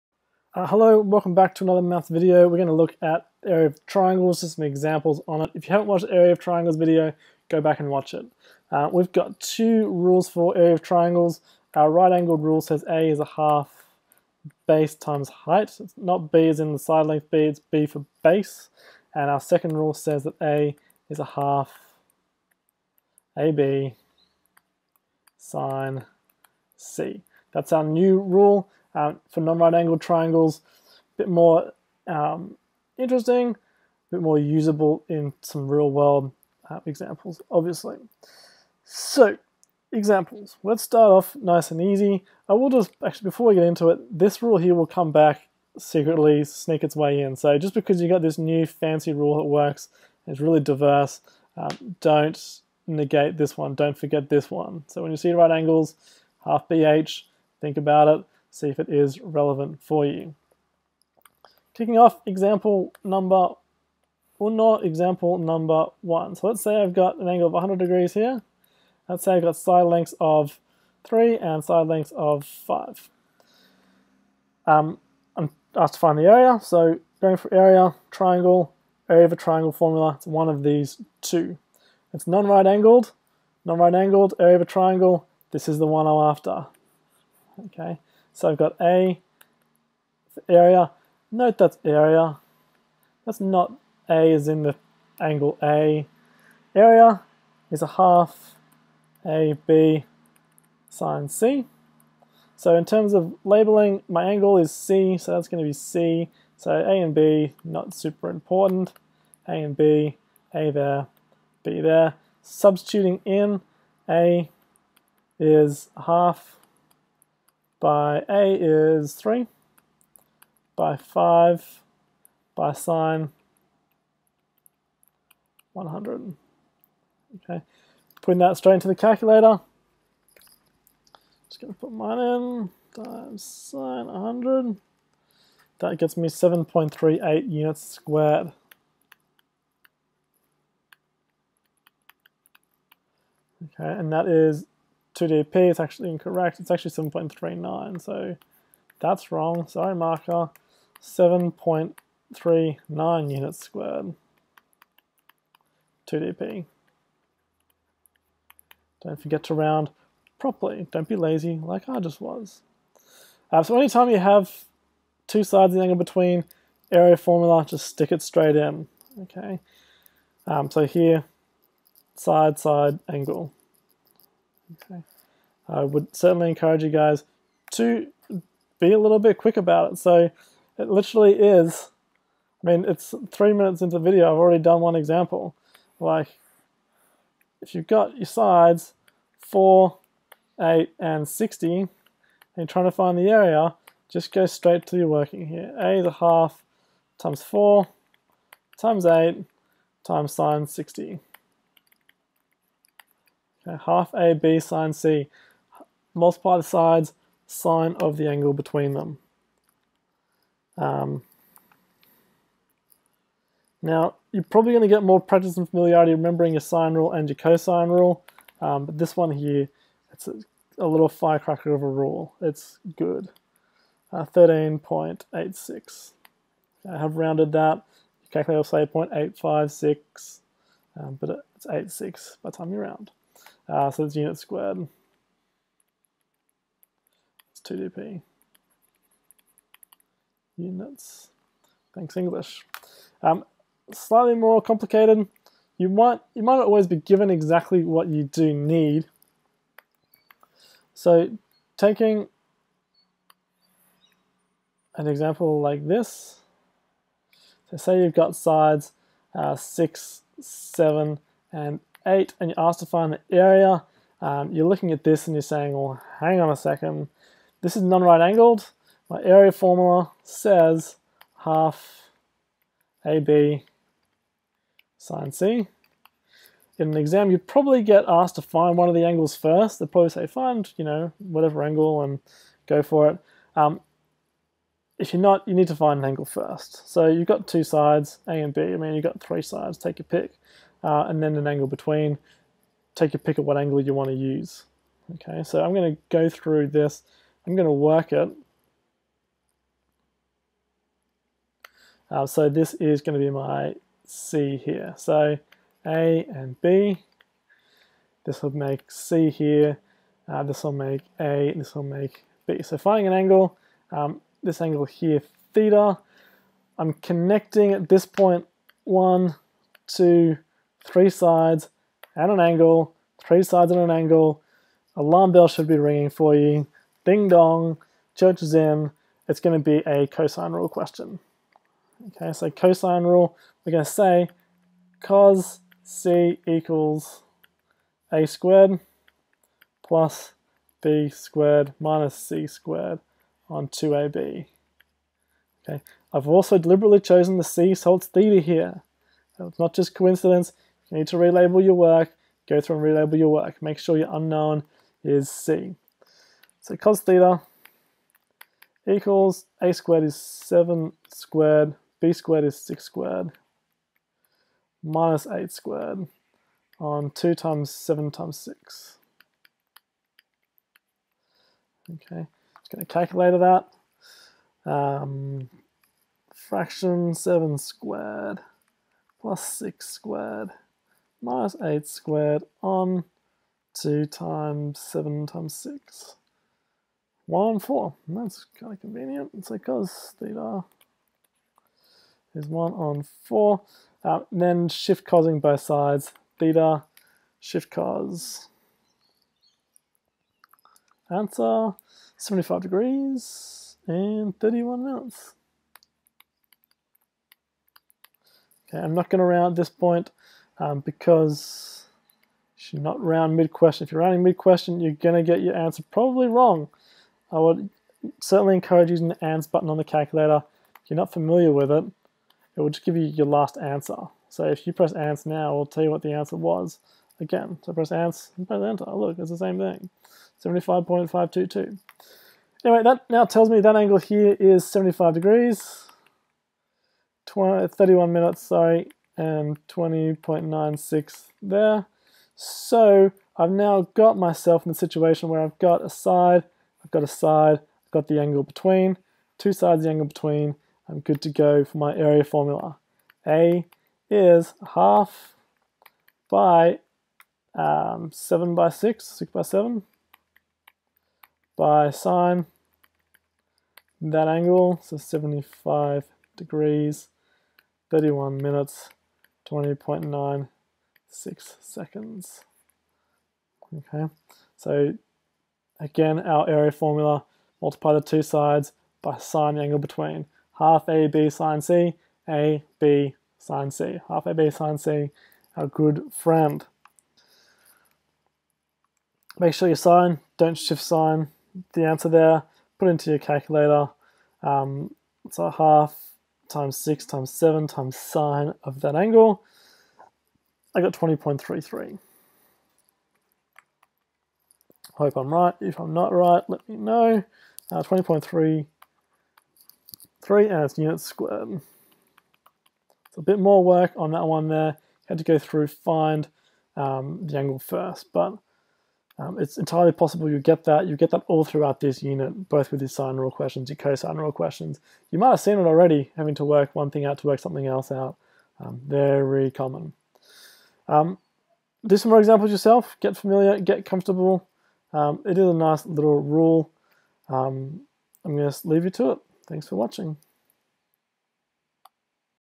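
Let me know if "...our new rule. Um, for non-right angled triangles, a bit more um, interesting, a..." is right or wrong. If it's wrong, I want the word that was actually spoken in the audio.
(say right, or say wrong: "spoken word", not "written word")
right.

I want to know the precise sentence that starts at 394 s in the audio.
Uh, then shift causing both sides.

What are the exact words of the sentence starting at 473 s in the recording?
Okay, so again, our area formula, multiply the two sides by sine angle between.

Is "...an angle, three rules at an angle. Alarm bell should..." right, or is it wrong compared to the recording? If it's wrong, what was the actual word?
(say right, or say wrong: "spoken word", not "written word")
wrong: "sides", not "rules".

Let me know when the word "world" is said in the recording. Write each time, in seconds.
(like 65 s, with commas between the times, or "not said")
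35 s.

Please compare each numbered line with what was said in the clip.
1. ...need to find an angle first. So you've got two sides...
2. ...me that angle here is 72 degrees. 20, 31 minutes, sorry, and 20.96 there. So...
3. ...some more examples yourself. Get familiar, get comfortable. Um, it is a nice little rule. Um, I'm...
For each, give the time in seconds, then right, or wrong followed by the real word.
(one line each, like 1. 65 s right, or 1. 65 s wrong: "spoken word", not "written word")
1. 285 s right
2. 433 s wrong: "75", not "72"
3. 531 s right.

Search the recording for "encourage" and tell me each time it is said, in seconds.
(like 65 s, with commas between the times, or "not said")
176 s, 418 s.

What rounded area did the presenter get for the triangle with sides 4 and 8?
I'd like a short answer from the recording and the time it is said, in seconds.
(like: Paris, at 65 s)
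13.86, at 224 s.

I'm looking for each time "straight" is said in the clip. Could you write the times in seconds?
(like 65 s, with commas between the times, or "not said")
128 s, 168 s, 194 s.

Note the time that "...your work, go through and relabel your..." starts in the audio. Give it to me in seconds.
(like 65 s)
351 s.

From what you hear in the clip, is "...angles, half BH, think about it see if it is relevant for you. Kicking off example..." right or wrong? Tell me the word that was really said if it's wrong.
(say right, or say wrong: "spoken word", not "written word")
right.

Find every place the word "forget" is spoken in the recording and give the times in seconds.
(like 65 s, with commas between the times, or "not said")
53 s, 159 s.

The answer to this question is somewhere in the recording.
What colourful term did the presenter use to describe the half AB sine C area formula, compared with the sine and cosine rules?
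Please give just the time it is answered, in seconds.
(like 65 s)
220 s.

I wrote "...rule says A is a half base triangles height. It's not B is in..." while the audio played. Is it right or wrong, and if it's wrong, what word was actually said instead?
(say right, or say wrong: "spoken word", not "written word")
wrong: "times", not "triangles".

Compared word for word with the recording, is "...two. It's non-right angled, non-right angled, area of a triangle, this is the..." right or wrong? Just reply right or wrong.
right.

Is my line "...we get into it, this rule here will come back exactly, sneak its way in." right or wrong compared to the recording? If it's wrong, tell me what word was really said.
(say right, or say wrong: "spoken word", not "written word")
wrong: "secretly", not "exactly".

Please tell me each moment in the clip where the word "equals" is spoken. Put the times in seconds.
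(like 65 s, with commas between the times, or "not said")
336 s, 358 s.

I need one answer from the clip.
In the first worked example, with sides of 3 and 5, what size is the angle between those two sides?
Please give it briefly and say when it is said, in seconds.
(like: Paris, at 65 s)
100 degrees, at 67 s.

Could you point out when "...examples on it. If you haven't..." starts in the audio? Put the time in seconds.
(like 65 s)
4 s.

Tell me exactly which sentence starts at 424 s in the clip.
So if you press ANS now, it will tell you what the answer was.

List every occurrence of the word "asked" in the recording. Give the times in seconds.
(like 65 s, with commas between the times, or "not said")
75 s, 262 s, 278 s.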